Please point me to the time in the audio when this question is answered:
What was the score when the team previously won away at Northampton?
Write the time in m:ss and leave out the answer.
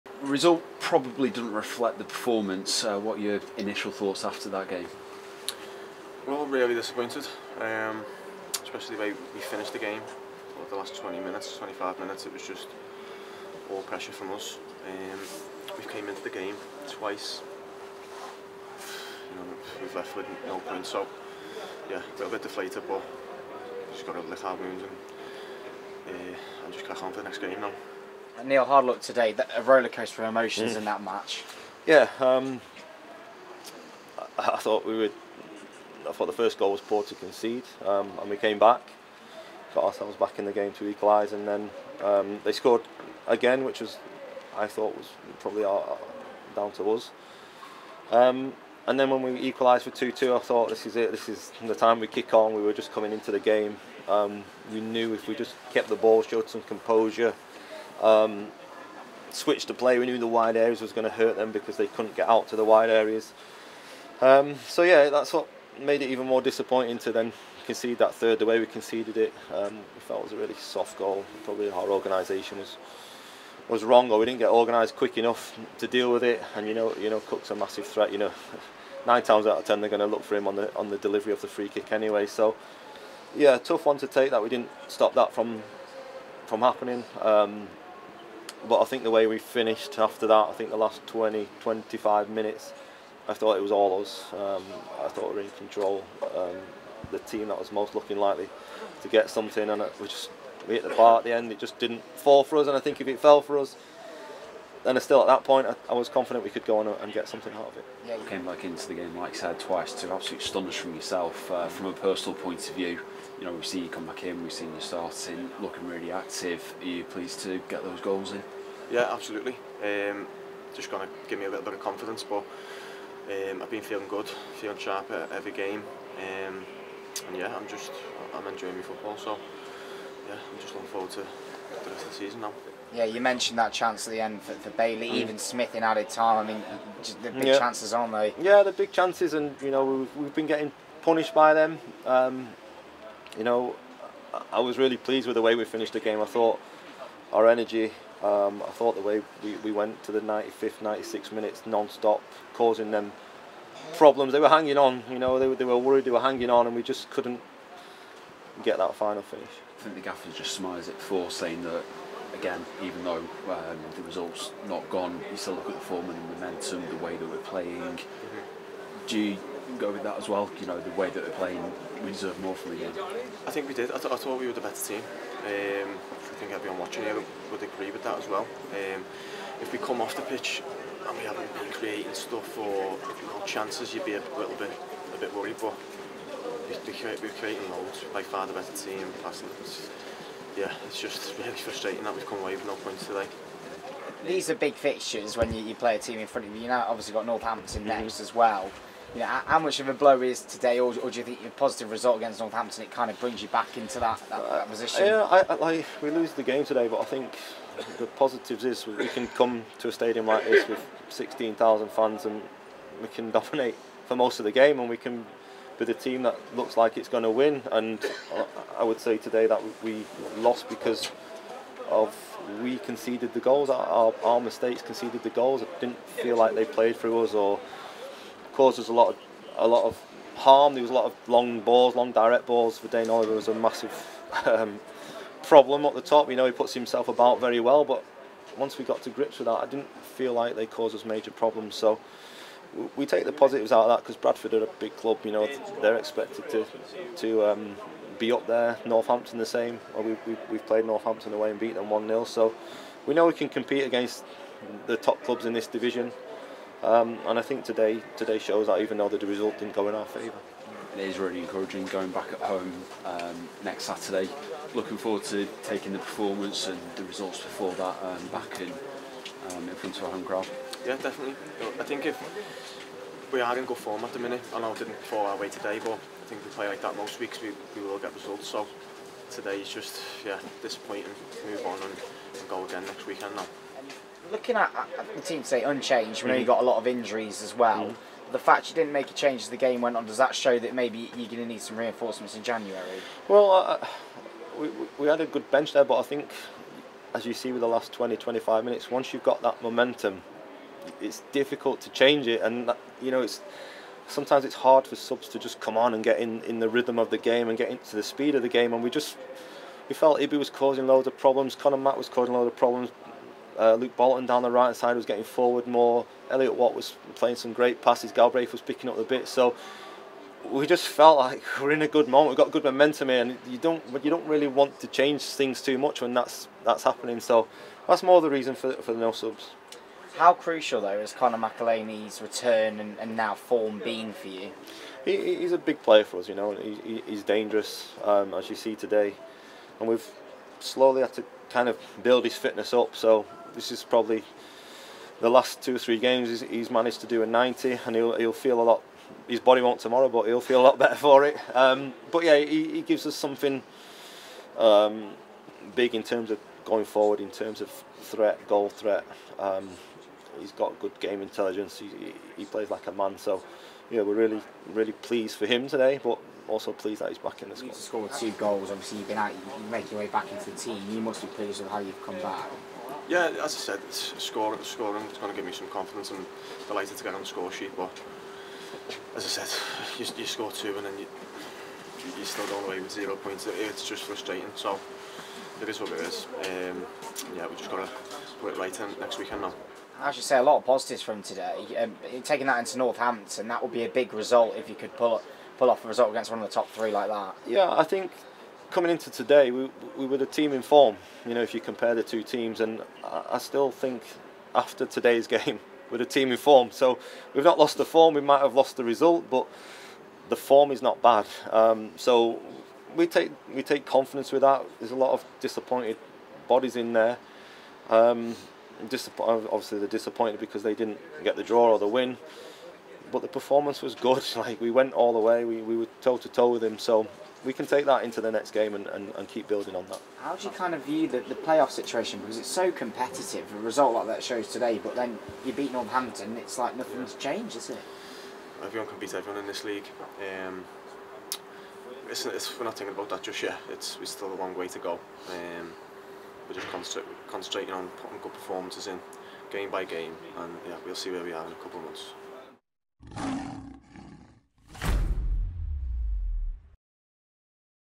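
4:11.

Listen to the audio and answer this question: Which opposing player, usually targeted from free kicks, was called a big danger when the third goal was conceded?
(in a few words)
Cook.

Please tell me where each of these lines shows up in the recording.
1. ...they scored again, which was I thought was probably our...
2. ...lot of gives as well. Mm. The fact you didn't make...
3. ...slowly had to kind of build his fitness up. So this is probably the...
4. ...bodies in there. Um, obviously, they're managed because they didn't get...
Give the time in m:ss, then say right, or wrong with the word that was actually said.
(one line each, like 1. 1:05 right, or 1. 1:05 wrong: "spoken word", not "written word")
1. 0:42 right
2. 4:46 wrong: "injuries", not "gives"
3. 5:40 right
4. 6:56 wrong: "disappointed", not "managed".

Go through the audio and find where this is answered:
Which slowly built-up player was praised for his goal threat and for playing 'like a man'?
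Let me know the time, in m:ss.
5:31.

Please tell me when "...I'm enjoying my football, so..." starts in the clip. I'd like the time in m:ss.
2:08.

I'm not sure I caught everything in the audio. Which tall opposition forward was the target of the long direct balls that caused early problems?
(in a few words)
Vadaine Oliver.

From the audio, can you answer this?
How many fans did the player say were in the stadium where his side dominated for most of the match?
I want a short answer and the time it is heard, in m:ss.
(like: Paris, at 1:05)
16,000, at 3:31.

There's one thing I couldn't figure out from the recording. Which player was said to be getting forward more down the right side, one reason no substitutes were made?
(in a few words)
Luke Bolton.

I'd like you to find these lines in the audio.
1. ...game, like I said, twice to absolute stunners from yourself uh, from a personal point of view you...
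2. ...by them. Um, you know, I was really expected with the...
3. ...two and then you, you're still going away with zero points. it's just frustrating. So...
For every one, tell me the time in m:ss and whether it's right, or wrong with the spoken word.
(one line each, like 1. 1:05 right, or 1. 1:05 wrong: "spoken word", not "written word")
1. 1:48 right
2. 2:21 wrong: "pleased", not "expected"
3. 6:20 right.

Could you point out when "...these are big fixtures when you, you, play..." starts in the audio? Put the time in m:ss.
3:14.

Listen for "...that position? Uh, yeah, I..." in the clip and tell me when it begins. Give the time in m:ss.
3:24.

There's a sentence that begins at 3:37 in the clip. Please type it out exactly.
And uh, I would say today that we lost because of we conceded the goals.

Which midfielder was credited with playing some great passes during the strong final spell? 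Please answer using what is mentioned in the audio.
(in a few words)
Elliot Watt.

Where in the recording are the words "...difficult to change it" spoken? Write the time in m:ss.
5:01.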